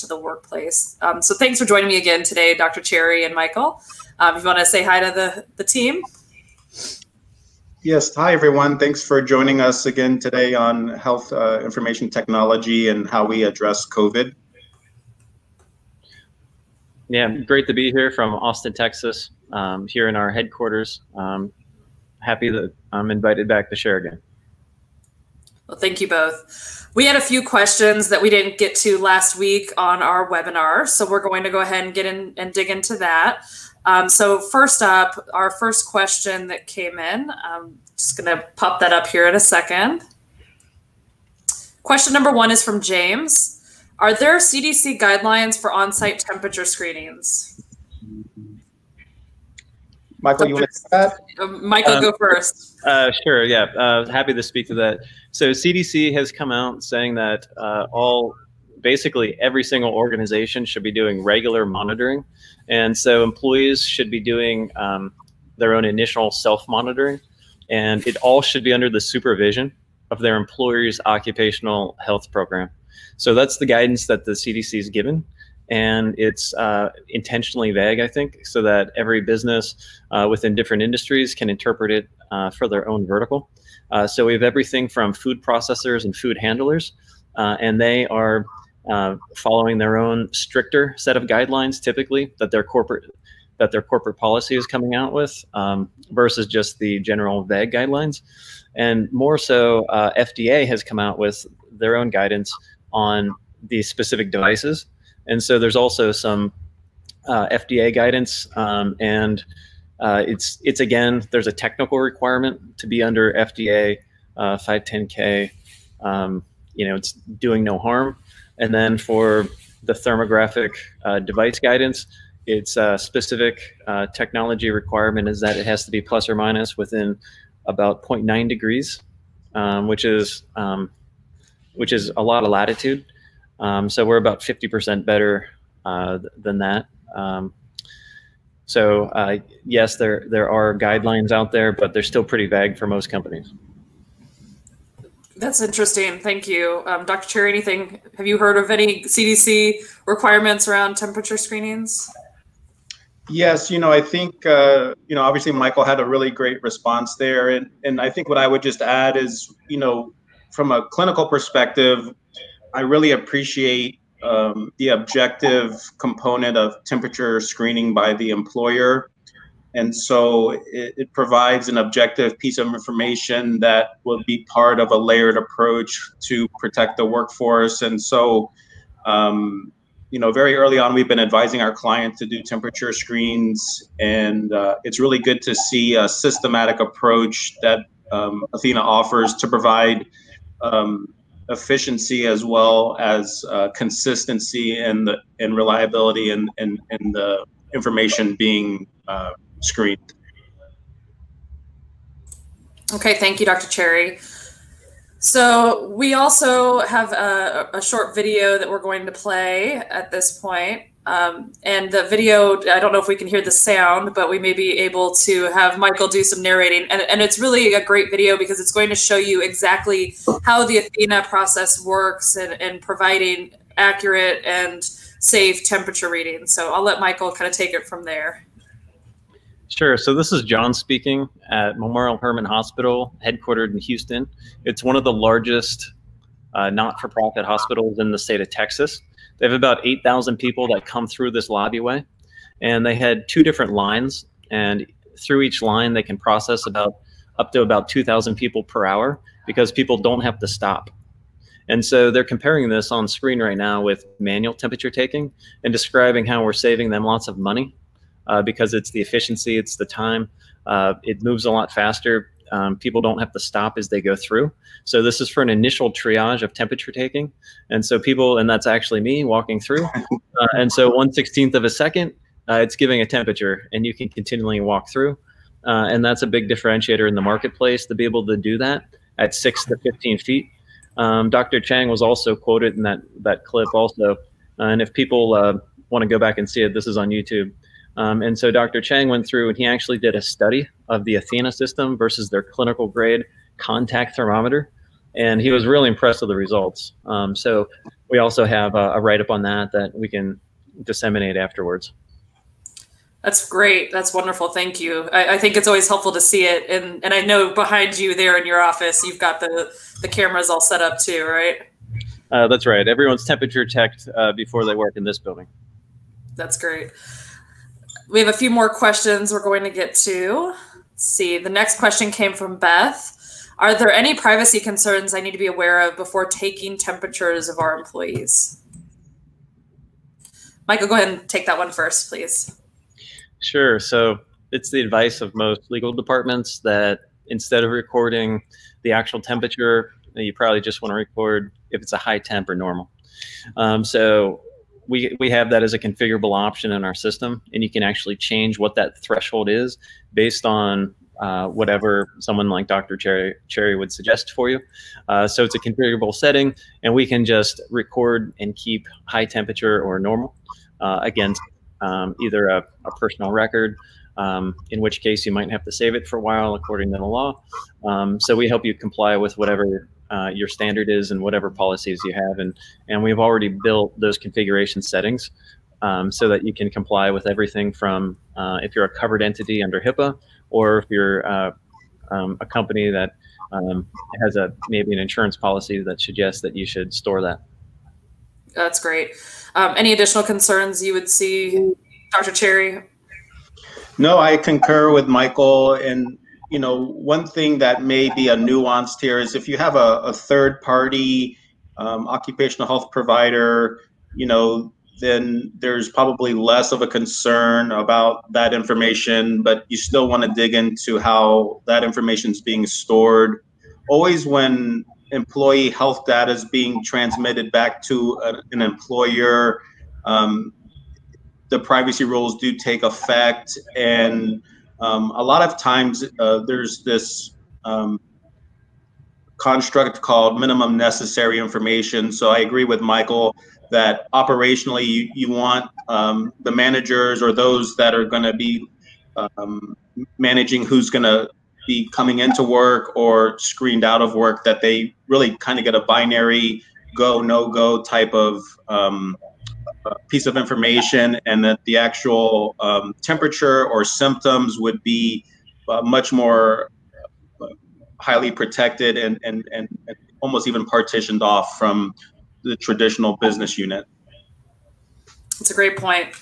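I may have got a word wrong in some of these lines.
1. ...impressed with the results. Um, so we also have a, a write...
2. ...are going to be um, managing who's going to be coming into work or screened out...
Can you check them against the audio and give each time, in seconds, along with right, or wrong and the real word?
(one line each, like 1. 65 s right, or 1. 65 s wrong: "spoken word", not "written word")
1. 295 s right
2. 437 s right.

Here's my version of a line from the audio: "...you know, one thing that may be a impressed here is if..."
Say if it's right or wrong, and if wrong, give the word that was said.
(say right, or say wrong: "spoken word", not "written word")
wrong: "nuanced", not "impressed".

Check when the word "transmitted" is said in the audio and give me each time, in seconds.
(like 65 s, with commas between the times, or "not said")
416 s.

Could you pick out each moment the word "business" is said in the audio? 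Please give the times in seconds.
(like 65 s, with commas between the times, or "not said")
79 s, 463 s.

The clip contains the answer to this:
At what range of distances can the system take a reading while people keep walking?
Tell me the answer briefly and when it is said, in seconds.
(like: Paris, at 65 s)
6 to 15 feet, at 279 s.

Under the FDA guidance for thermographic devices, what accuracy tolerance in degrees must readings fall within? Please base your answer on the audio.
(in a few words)
0.9 degrees.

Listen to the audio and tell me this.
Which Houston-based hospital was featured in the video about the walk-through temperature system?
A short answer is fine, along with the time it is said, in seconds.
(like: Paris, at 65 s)
Memorial Hermann Hospital, at 231 s.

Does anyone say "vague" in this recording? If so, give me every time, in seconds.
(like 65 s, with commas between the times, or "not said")
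77 s, 97 s, 142 s.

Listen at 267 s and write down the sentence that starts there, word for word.
And so people, and that's actually me walking through.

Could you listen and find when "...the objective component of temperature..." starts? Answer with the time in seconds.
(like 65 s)
164 s.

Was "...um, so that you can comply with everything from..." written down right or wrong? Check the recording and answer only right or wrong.
right.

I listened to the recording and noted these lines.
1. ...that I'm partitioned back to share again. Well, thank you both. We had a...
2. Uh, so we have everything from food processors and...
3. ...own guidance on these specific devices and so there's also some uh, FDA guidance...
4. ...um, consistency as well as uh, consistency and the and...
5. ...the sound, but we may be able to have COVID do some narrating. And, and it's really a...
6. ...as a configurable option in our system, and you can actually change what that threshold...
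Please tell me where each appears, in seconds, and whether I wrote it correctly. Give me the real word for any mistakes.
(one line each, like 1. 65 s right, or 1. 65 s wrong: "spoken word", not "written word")
1. 22 s wrong: "invited", not "partitioned"
2. 83 s right
3. 101 s right
4. 190 s wrong: "efficiency", not "consistency"
5. 213 s wrong: "Michael", not "COVID"
6. 345 s right.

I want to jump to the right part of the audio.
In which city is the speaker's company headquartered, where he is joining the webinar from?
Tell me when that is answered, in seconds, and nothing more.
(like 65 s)
18 s.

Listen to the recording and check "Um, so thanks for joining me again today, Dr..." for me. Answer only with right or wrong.
right.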